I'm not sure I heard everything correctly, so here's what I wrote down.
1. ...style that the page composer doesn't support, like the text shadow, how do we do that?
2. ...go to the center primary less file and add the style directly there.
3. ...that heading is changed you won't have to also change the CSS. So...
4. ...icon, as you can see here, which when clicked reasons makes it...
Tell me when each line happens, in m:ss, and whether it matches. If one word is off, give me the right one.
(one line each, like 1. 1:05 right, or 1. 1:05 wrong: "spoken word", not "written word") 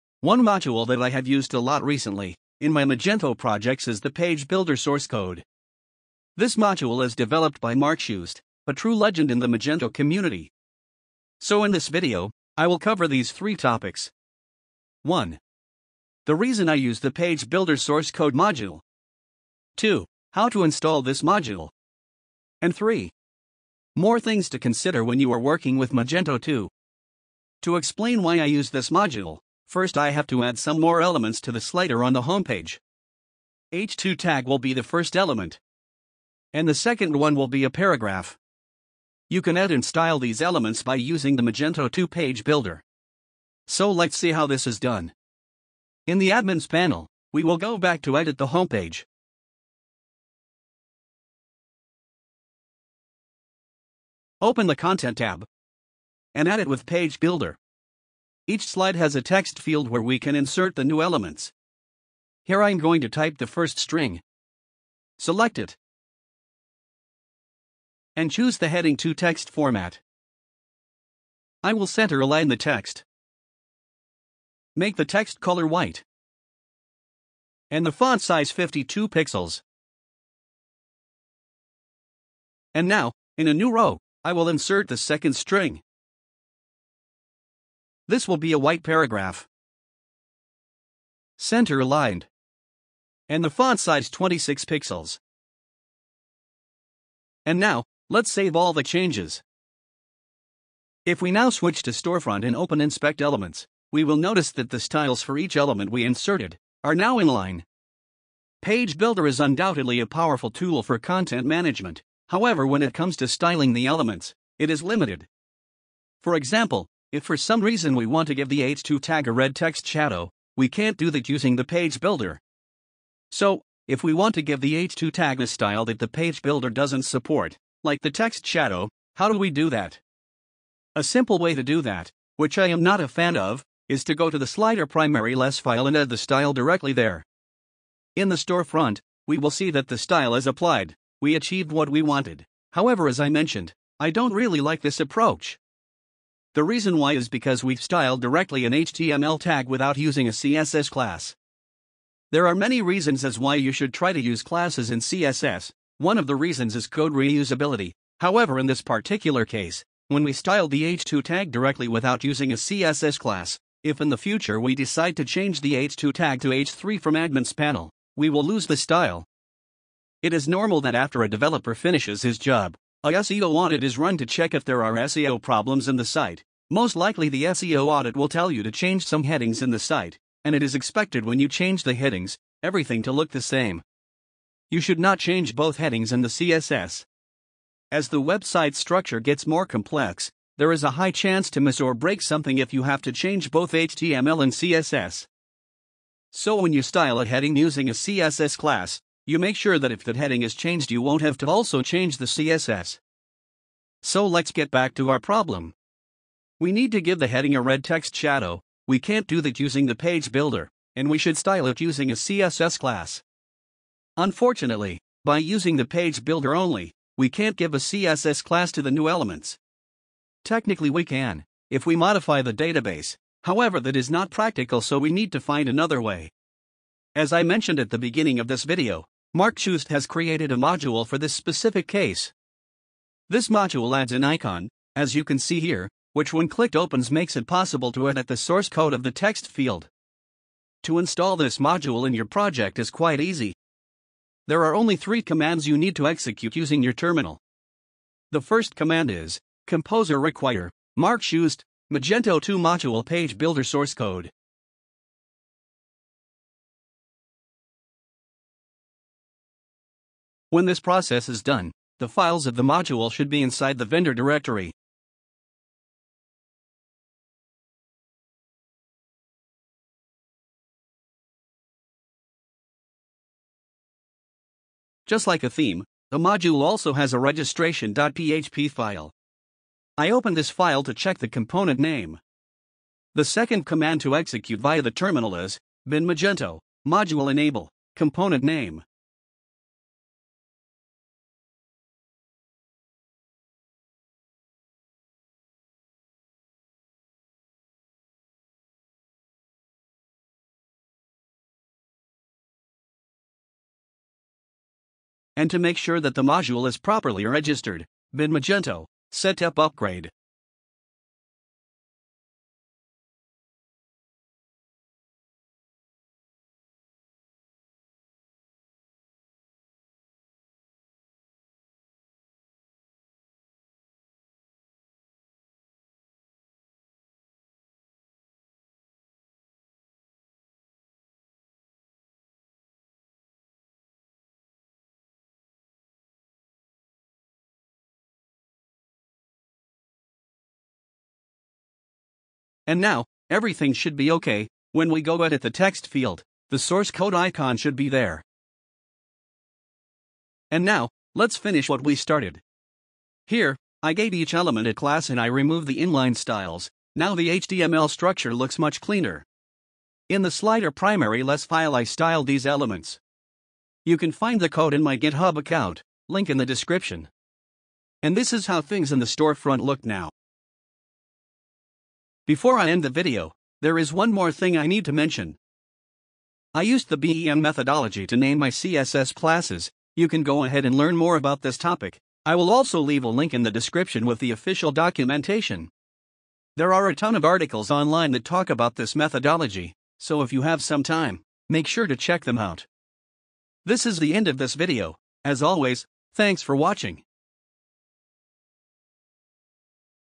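1. 2:05 wrong: "builder", not "composer"
2. 2:14 wrong: "slider", not "center"
3. 3:20 right
4. 3:54 wrong: "opens", not "reasons".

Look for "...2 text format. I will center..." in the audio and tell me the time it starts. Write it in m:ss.
1:08.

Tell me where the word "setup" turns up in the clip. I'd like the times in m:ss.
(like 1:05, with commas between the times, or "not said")
5:09.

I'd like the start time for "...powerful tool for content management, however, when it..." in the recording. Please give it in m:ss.
1:50.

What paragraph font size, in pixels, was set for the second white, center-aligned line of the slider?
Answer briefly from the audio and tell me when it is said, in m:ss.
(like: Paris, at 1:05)
26, at 1:34.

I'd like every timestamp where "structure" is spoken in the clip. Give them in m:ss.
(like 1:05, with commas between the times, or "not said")
3:08, 5:57.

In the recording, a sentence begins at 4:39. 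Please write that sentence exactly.
I open this file to check the component name.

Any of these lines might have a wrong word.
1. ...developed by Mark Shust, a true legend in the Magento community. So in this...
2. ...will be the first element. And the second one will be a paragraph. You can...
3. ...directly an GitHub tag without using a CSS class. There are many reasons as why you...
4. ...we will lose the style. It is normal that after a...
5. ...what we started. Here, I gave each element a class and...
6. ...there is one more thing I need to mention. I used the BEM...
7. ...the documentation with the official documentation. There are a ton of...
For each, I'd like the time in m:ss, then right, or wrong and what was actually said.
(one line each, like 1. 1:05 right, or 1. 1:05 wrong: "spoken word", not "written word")
1. 0:07 right
2. 0:34 right
3. 2:28 wrong: "HTML", not "GitHub"
4. 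2:48 right
5. 5:51 right
6. 6:13 right
7. 6:23 wrong: "description", not "documentation".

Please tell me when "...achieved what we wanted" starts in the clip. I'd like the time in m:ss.
2:21.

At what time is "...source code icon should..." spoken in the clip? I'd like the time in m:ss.
5:46.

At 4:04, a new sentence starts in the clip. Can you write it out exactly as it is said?
There are only three commands you need to execute using your terminal.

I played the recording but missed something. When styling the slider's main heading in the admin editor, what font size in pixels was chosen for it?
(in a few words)
52.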